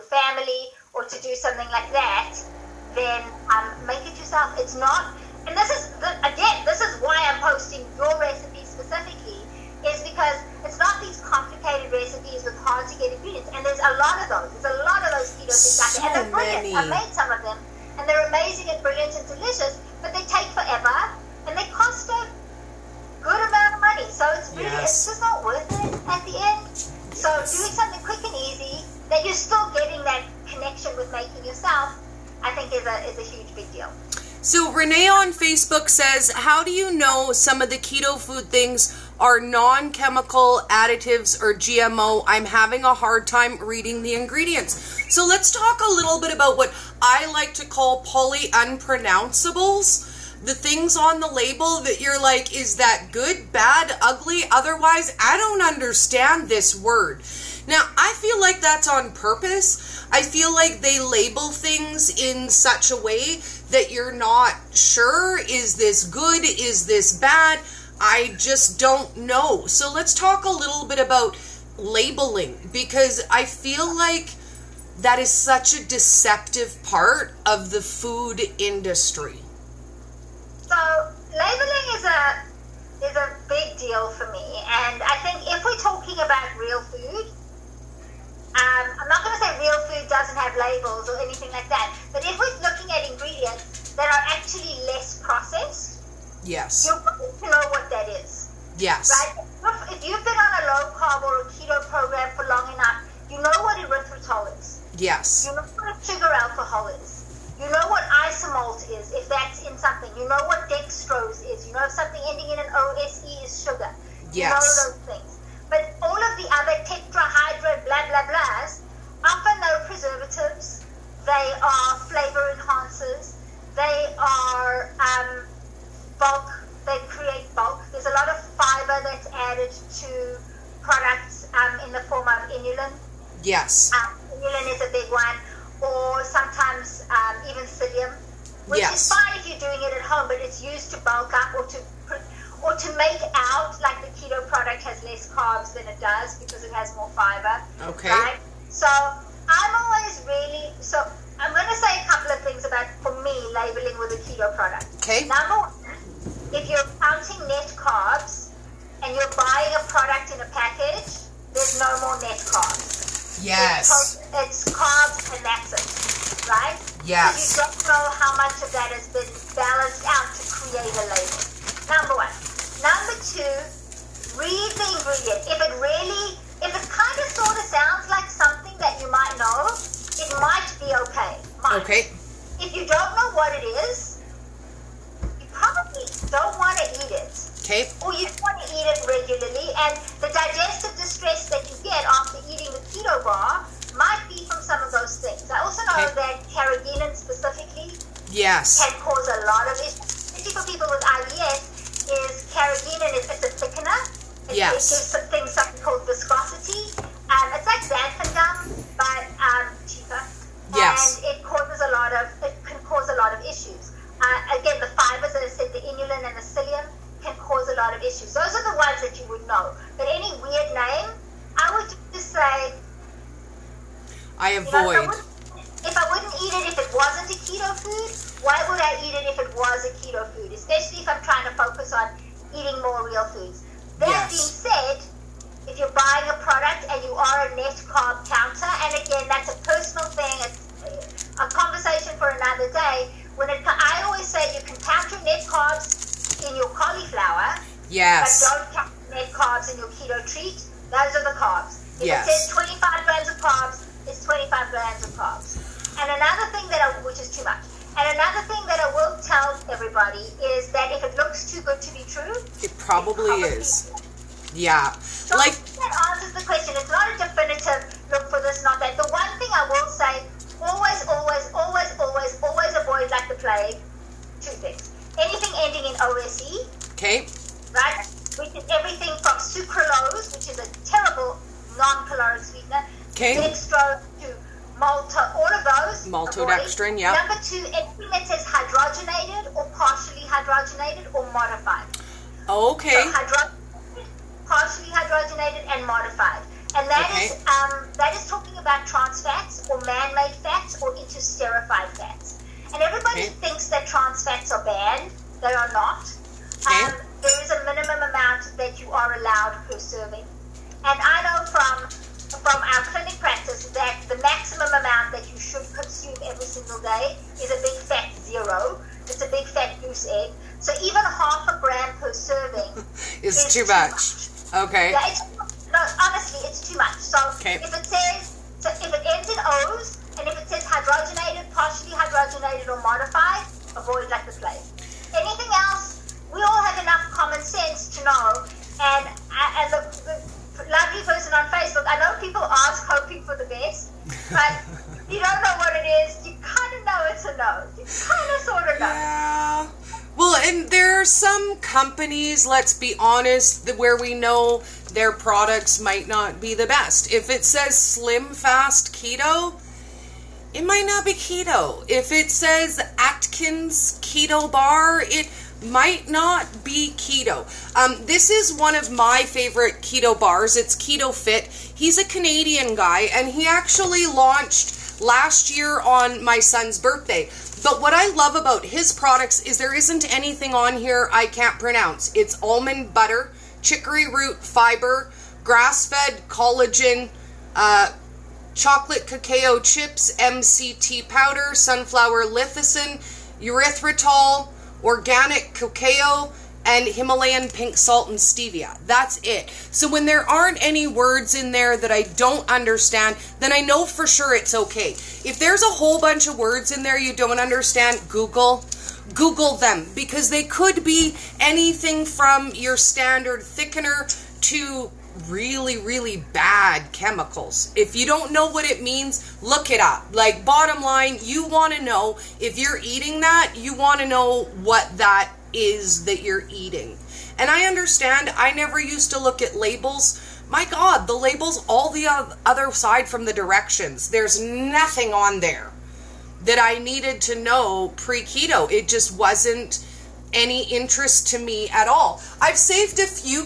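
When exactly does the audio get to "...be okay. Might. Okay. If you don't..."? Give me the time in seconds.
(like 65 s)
180 s.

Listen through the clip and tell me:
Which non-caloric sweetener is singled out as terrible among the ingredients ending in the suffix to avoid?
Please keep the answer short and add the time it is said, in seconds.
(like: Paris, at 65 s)
sucralose, at 279 s.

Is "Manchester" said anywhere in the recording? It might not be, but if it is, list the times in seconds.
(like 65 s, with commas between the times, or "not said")
not said.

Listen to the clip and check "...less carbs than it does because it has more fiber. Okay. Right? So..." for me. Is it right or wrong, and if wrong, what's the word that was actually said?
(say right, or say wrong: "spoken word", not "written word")
right.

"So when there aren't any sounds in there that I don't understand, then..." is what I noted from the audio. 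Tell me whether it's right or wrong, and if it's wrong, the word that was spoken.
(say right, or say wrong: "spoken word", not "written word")
wrong: "words", not "sounds".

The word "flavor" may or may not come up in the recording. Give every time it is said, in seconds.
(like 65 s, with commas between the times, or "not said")
122 s.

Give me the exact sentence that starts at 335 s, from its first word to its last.
Anything else, we all have enough common sense to know.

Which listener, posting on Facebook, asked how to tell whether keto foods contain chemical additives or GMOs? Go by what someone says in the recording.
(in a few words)
Renee.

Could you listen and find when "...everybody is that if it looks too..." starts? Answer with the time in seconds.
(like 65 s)
259 s.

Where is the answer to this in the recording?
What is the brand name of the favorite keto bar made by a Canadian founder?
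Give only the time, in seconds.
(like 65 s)
370 s.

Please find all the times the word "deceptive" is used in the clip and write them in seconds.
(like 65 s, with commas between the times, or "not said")
75 s.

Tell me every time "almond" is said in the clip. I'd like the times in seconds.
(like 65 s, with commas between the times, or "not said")
382 s.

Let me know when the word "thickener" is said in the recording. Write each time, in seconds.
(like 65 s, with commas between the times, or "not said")
203 s, 413 s.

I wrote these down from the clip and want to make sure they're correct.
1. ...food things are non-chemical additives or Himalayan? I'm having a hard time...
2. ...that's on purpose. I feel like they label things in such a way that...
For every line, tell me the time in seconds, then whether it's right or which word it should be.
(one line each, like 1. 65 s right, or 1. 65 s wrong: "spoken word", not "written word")
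1. 38 s wrong: "GMO", not "Himalayan"
2. 58 s right.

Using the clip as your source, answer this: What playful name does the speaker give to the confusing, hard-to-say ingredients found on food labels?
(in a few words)
poly unpronounceables.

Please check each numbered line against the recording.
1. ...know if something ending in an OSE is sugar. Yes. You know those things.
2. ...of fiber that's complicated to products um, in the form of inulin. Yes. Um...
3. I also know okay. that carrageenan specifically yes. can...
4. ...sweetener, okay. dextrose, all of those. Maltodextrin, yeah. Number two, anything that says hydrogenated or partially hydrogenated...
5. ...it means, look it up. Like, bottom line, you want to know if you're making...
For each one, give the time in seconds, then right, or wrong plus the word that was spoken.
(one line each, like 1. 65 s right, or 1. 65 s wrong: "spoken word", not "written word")
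1. 111 s right
2. 128 s wrong: "added", not "complicated"
3. 195 s right
4. 282 s right
5. 418 s wrong: "eating", not "making".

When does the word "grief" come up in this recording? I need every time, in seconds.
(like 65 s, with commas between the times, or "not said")
not said.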